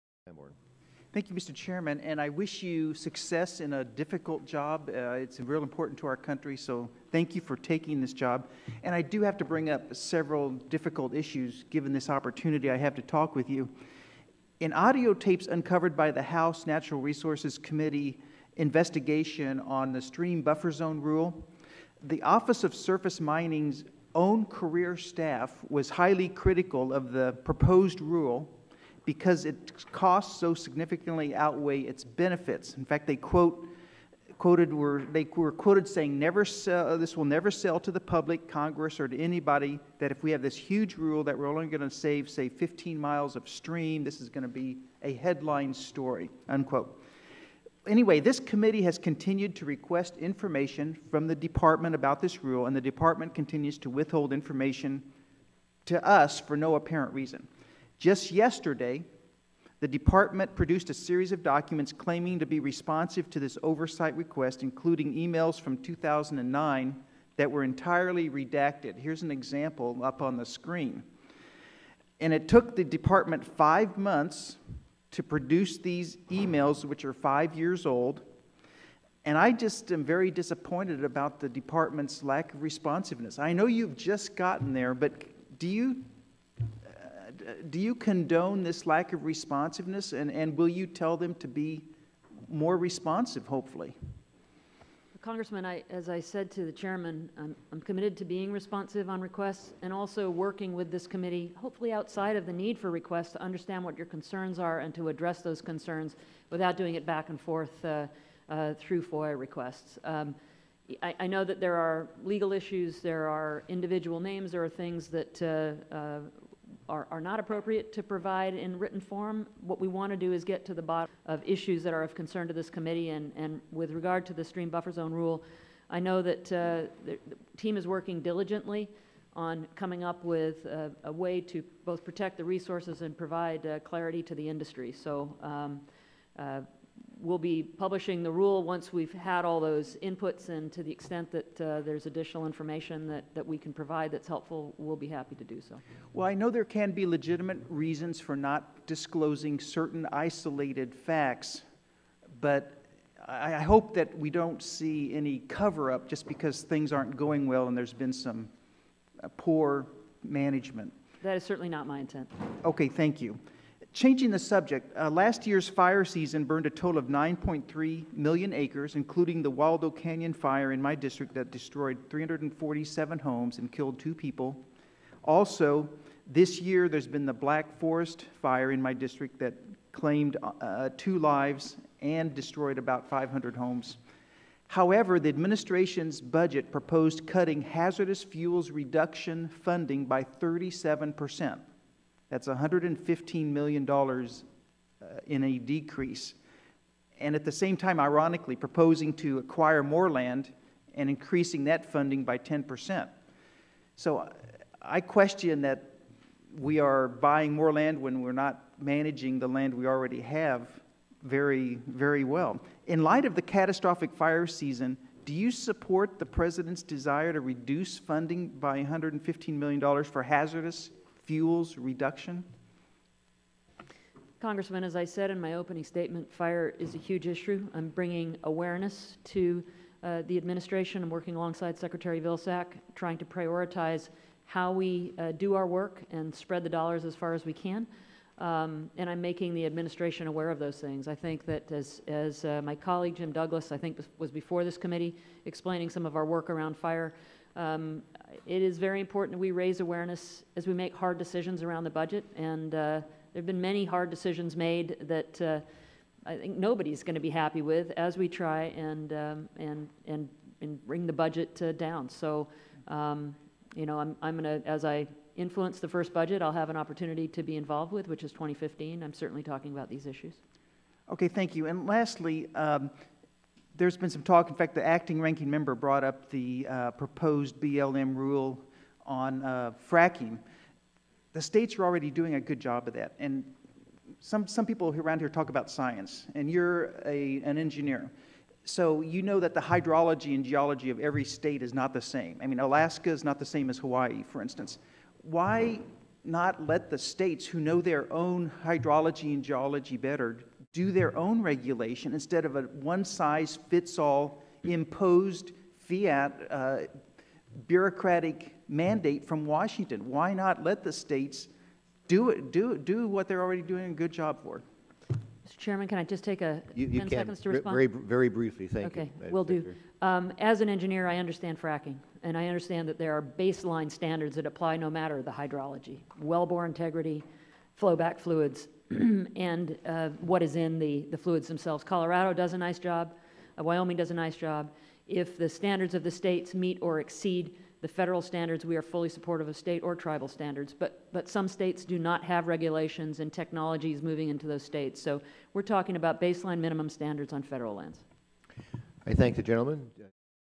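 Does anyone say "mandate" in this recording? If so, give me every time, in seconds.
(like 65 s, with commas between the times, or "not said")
308 s.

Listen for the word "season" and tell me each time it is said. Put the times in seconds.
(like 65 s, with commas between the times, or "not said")
166 s, 214 s.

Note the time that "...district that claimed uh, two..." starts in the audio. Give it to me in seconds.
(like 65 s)
178 s.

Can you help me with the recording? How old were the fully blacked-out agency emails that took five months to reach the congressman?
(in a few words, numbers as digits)
five years.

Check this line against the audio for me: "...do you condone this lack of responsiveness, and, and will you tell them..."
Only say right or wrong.
right.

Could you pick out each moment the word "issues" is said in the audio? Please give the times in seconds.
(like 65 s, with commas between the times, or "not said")
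11 s, 112 s, 121 s, 227 s, 270 s.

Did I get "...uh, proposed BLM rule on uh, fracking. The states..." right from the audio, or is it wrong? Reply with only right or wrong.
right.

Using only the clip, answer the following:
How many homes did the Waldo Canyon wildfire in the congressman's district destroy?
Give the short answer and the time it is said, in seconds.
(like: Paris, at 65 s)
347, at 172 s.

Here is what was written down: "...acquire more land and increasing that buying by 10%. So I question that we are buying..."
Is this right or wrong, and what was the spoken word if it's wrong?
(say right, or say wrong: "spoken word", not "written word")
wrong: "funding", not "buying".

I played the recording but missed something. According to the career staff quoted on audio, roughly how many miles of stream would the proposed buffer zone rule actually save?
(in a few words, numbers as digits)
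15 miles.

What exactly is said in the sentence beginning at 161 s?
That is certainly not my intent.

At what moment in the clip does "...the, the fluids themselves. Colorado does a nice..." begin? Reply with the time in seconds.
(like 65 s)
330 s.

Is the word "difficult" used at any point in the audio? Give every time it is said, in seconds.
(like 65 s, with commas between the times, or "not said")
3 s, 10 s.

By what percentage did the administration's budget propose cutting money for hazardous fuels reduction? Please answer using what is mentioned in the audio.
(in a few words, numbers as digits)
37 percent.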